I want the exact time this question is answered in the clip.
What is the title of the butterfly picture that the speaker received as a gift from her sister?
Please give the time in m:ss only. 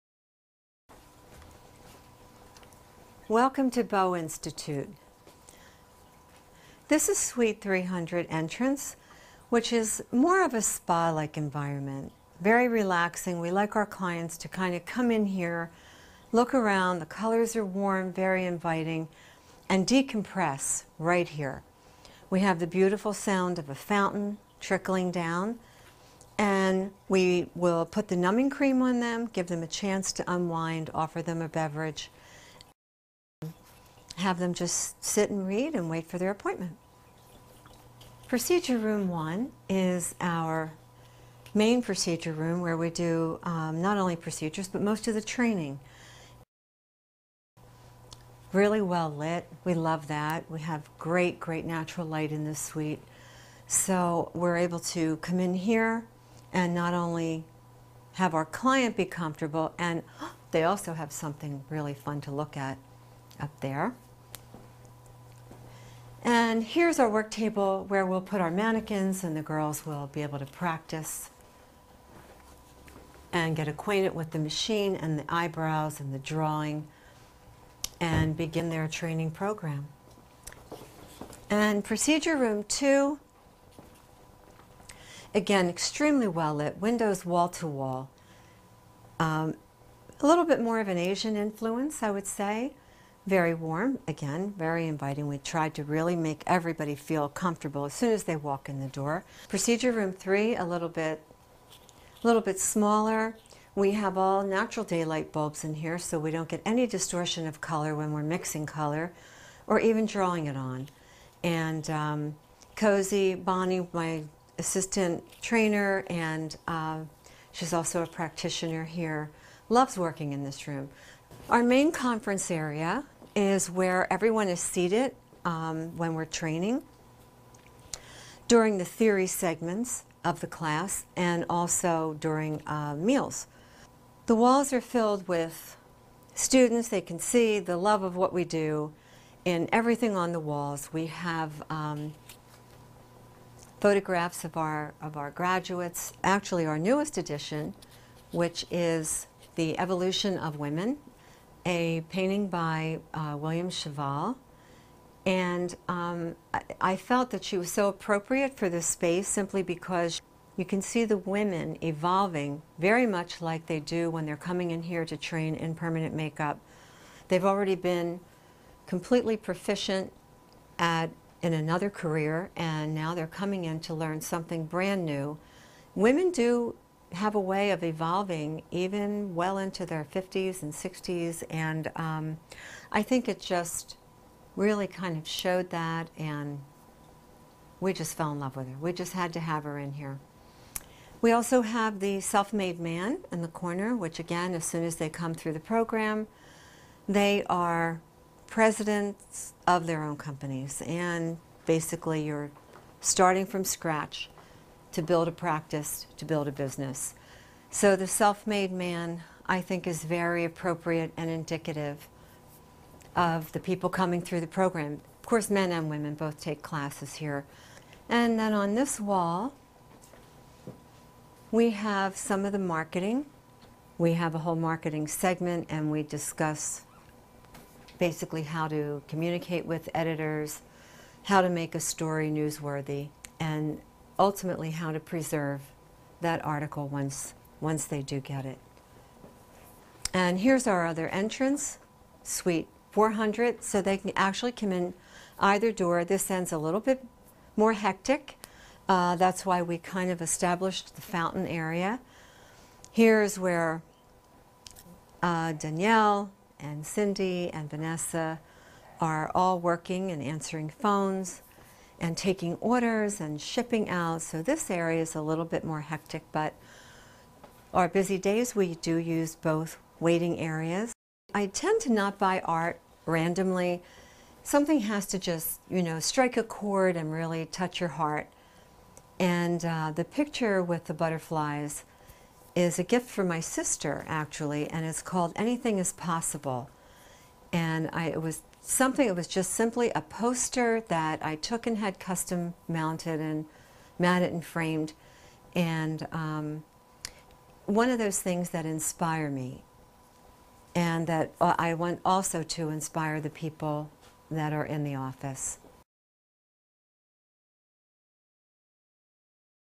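4:45.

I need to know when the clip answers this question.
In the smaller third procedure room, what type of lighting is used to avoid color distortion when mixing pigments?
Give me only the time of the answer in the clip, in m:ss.
1:44.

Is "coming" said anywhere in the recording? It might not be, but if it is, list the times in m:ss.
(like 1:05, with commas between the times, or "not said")
2:44, 2:53, 3:33.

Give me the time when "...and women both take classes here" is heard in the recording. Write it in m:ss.
3:35.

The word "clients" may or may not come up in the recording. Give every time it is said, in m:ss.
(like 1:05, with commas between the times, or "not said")
0:13, 0:58.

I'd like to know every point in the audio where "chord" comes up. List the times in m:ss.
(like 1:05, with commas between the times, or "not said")
4:36.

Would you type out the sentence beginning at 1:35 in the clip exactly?
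We tried to really make everybody feel comfortable as soon as they walk in the door.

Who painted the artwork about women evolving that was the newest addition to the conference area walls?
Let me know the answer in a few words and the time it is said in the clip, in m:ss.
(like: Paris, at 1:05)
William Cheval, at 2:33.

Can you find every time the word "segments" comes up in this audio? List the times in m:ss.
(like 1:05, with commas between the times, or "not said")
2:09, 3:45.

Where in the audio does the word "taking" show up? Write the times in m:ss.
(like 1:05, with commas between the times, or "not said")
4:22.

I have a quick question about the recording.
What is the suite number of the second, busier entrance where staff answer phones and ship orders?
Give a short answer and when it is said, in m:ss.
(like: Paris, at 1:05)
400, at 4:02.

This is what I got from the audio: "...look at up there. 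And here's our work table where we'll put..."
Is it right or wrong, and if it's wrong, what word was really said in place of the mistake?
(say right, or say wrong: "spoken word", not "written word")
right.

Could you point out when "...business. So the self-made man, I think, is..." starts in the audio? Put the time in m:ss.
3:26.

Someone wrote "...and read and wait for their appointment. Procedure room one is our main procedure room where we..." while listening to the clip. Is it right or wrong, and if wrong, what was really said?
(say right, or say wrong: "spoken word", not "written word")
right.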